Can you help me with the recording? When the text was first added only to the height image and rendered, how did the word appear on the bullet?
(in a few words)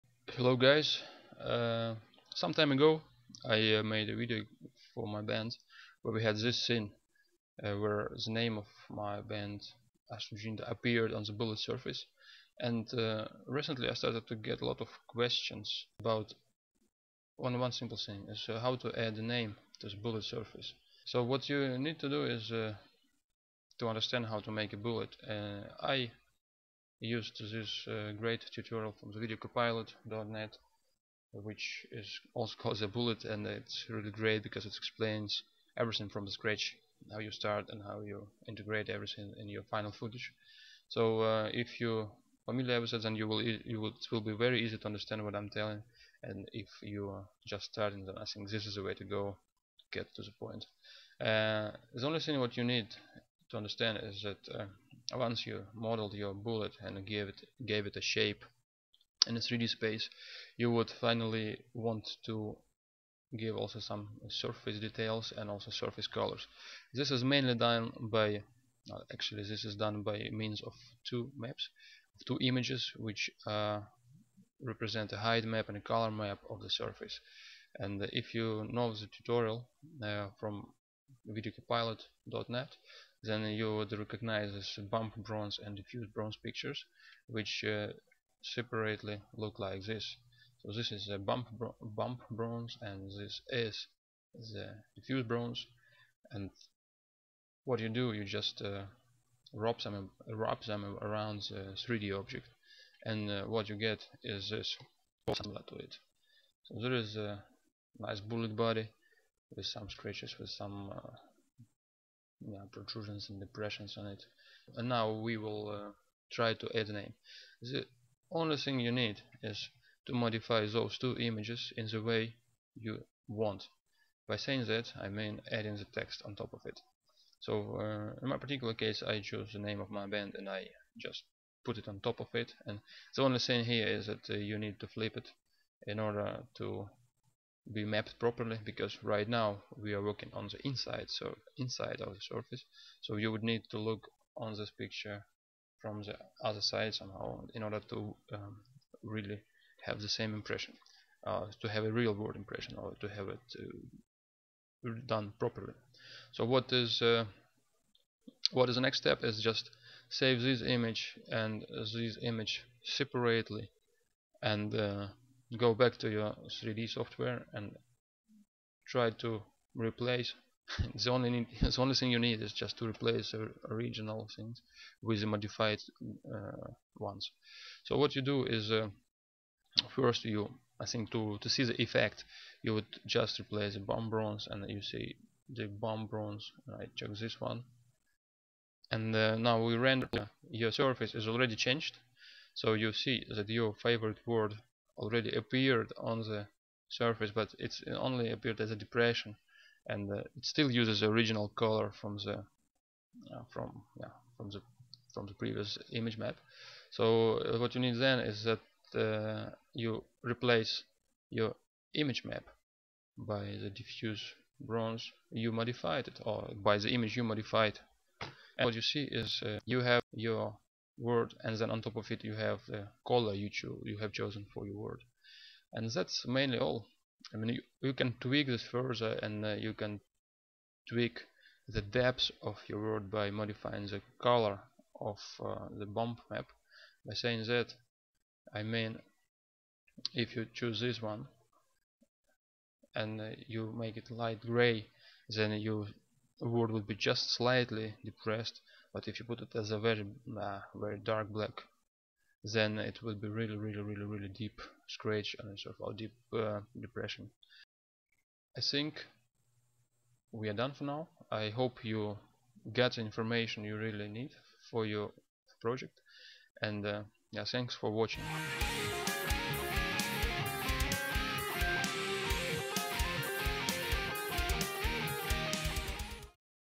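As a depression.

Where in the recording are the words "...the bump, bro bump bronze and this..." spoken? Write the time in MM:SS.
01:31.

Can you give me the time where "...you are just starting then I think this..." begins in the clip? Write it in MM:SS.
00:46.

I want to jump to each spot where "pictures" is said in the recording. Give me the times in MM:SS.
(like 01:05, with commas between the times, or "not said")
01:26, 02:24.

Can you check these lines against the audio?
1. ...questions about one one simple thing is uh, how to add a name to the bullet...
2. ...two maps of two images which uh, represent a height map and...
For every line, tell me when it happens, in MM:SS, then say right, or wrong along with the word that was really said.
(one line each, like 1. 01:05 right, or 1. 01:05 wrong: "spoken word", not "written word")
1. 00:15 right
2. 01:11 right.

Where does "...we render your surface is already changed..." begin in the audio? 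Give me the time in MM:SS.
03:09.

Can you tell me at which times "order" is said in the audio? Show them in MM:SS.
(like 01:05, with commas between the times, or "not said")
02:15, 02:27.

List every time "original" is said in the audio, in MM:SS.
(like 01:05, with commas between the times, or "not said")
02:53, 03:21.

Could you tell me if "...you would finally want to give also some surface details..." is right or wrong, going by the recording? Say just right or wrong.
right.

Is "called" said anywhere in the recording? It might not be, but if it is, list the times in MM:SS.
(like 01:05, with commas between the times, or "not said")
00:32.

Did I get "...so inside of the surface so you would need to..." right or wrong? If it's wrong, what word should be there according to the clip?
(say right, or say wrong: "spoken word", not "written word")
right.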